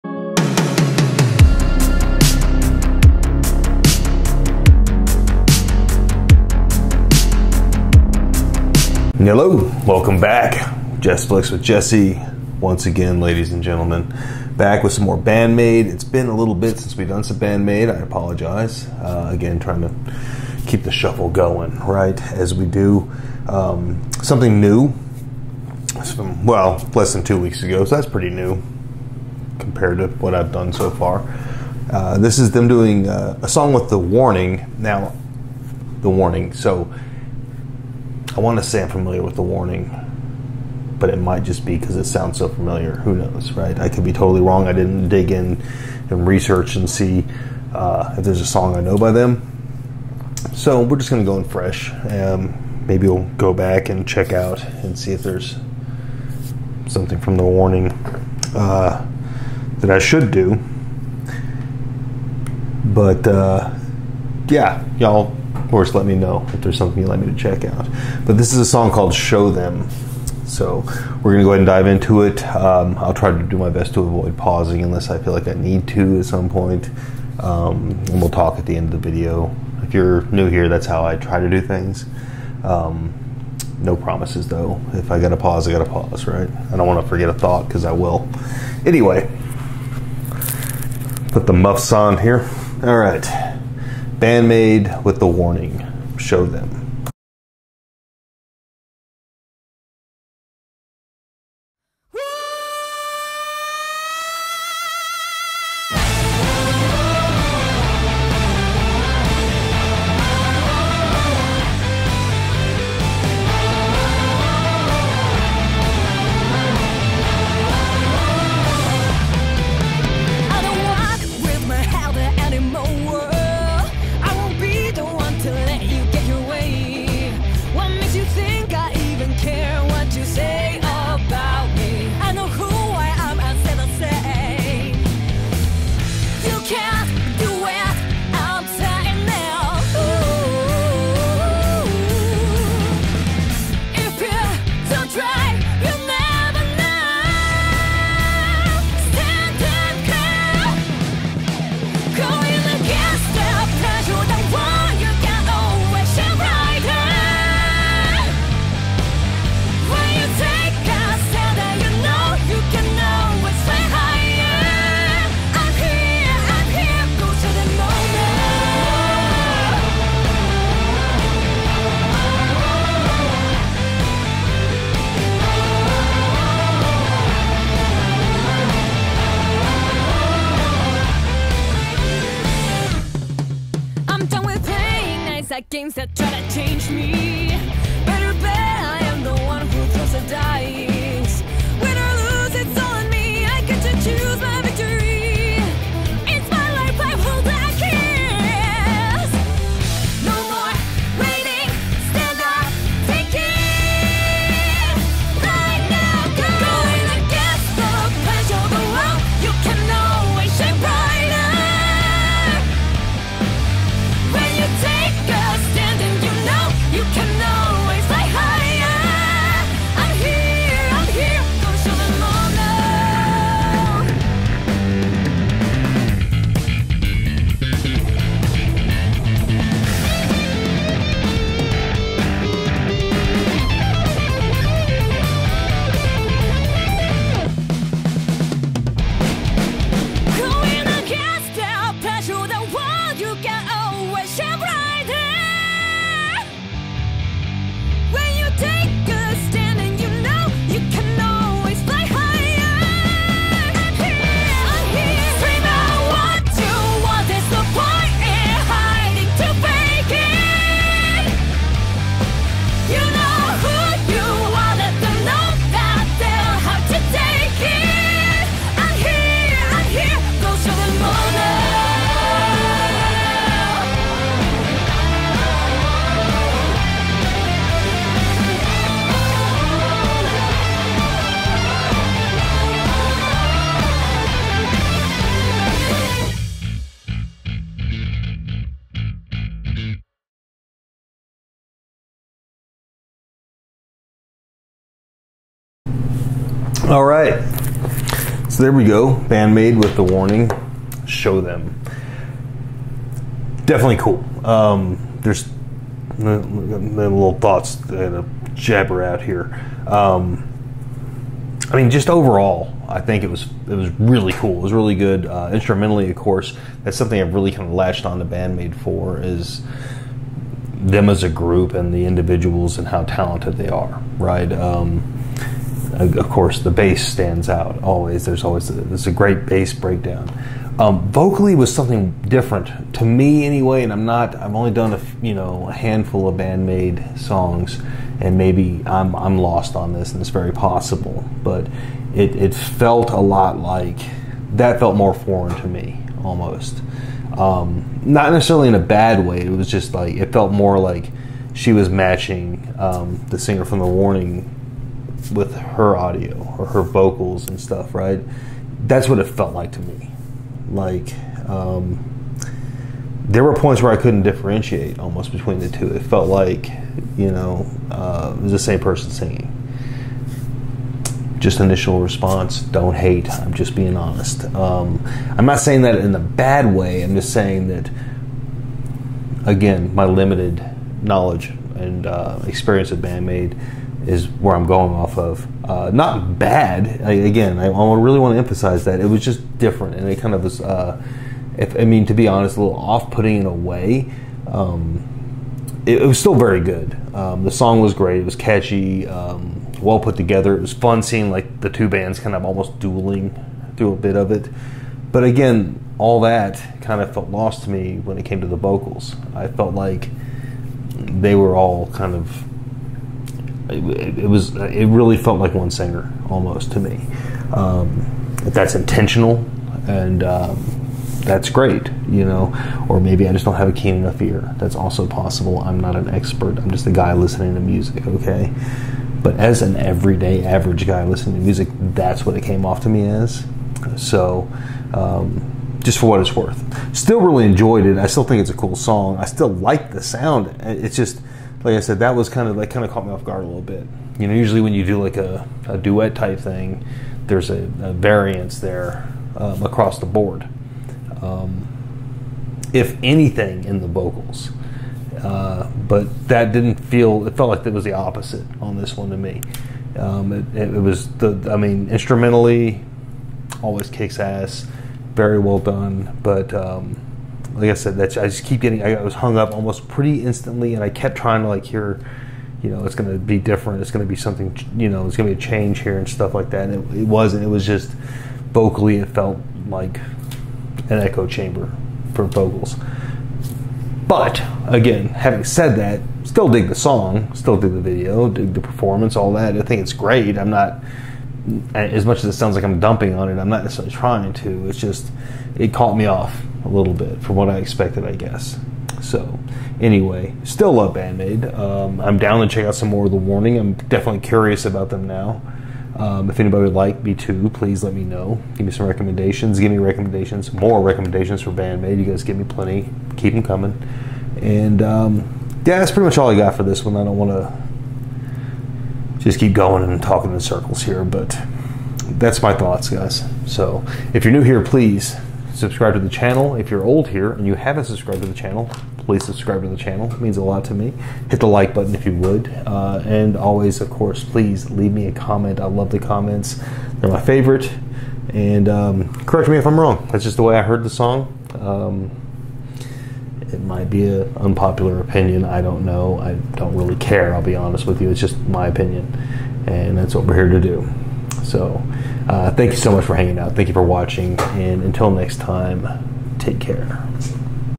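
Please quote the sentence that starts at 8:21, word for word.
Um, I'm down to check out some more of The Warning.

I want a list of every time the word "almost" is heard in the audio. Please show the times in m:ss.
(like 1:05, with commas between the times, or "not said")
5:46, 6:04, 6:42, 6:56, 7:49.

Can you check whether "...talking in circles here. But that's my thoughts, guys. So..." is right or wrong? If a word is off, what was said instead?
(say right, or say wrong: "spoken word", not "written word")
right.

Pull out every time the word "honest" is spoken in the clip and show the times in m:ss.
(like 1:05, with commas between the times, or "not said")
6:13, 6:32, 9:07.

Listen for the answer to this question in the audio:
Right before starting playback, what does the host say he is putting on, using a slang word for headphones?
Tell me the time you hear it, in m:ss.
1:31.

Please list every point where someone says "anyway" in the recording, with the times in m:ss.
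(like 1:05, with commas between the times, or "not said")
1:28, 5:33, 8:19.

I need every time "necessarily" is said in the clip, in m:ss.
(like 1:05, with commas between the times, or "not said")
5:48, 8:13.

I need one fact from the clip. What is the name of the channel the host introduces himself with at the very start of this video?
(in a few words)
Jessflix.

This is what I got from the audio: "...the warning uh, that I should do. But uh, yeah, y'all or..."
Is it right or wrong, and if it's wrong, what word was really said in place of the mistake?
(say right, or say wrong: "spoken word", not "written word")
right.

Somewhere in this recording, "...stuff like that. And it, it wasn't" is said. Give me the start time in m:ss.
7:56.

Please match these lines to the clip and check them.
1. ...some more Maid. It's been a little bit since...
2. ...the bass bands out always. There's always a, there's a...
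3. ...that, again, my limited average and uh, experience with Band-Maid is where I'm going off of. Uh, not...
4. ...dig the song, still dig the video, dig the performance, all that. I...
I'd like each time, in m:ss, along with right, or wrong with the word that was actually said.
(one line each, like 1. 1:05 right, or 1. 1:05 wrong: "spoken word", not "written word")
1. 0:14 right
2. 5:26 wrong: "stands", not "bands"
3. 6:17 wrong: "knowledge", not "average"
4. 8:06 right.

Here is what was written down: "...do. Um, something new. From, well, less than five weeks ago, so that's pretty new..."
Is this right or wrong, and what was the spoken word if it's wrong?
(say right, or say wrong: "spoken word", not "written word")
wrong: "two", not "five".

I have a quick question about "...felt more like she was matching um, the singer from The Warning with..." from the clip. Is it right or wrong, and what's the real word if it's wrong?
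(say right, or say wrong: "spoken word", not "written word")
right.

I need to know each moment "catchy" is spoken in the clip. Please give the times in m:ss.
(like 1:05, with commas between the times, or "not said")
6:38.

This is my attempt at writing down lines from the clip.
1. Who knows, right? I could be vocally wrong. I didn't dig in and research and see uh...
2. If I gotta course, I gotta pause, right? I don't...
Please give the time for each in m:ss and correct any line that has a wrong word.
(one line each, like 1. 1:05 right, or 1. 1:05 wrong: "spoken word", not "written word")
1. 0:42 wrong: "totally", not "vocally"
2. 1:24 wrong: "pause", not "course".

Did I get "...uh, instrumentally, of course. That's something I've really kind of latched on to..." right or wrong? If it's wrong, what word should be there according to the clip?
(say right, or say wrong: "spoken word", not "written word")
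right.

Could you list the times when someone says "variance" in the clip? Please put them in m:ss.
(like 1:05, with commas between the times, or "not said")
7:27.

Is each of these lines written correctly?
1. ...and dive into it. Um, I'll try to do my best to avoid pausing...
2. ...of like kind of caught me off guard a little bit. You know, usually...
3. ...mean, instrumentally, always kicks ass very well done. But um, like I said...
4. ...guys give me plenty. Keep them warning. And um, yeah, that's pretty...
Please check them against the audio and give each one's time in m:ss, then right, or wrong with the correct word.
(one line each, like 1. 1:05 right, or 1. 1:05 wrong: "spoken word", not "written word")
1. 1:11 right
2. 7:22 right
3. 7:41 right
4. 8:32 wrong: "coming", not "warning".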